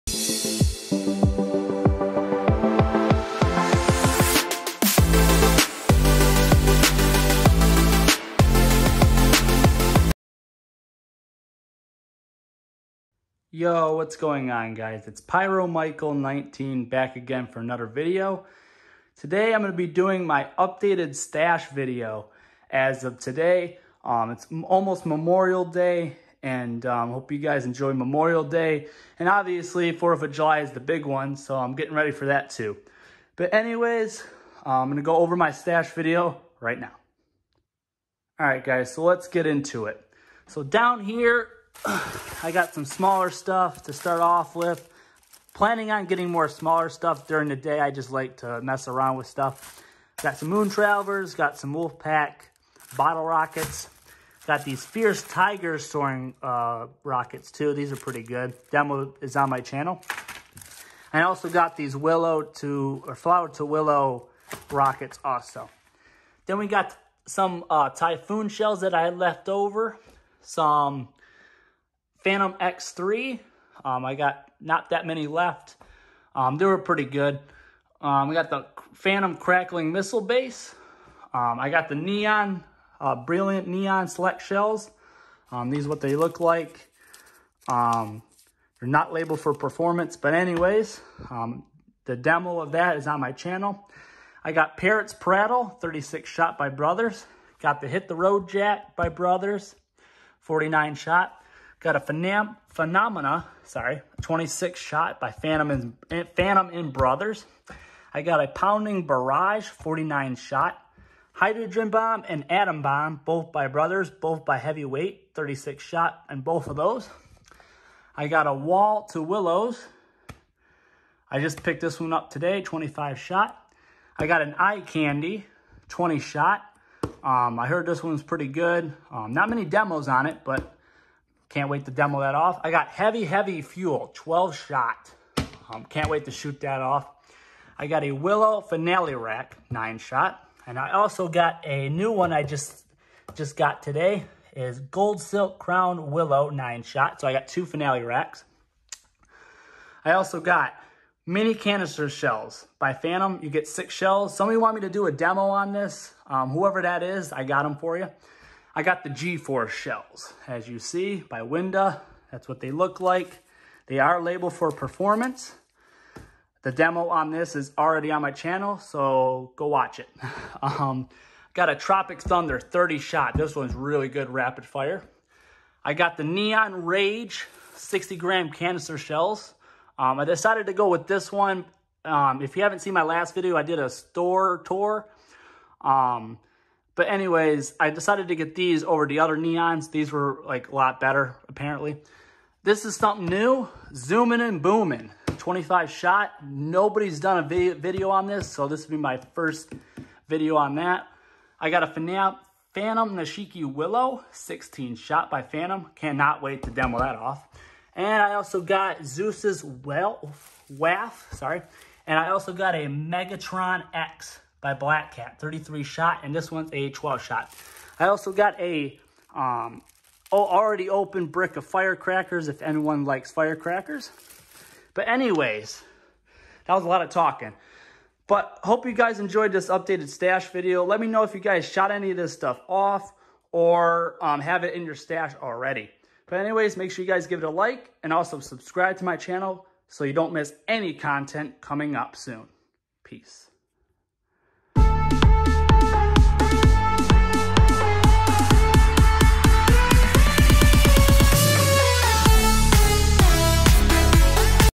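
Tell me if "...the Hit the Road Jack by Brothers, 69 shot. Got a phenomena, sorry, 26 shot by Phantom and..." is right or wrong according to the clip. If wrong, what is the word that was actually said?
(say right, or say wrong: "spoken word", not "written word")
wrong: "49", not "69".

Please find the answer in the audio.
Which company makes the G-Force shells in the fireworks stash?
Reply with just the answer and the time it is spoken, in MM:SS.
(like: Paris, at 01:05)
Winda, at 02:41.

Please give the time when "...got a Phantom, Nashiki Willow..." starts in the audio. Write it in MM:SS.
03:21.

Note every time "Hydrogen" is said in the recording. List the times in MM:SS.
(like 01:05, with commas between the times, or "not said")
01:51.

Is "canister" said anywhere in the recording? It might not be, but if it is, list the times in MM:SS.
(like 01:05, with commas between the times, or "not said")
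02:31, 02:58.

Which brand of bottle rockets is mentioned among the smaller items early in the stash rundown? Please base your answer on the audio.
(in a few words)
Wolfpack.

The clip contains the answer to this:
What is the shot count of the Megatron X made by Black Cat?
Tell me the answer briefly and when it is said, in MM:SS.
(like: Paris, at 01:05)
33, at 03:35.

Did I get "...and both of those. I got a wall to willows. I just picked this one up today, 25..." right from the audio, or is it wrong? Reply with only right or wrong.
right.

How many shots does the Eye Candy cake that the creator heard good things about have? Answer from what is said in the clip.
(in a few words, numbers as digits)
20.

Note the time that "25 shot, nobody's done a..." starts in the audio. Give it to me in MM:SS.
03:15.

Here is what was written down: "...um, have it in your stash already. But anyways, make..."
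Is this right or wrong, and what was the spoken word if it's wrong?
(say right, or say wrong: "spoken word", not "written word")
right.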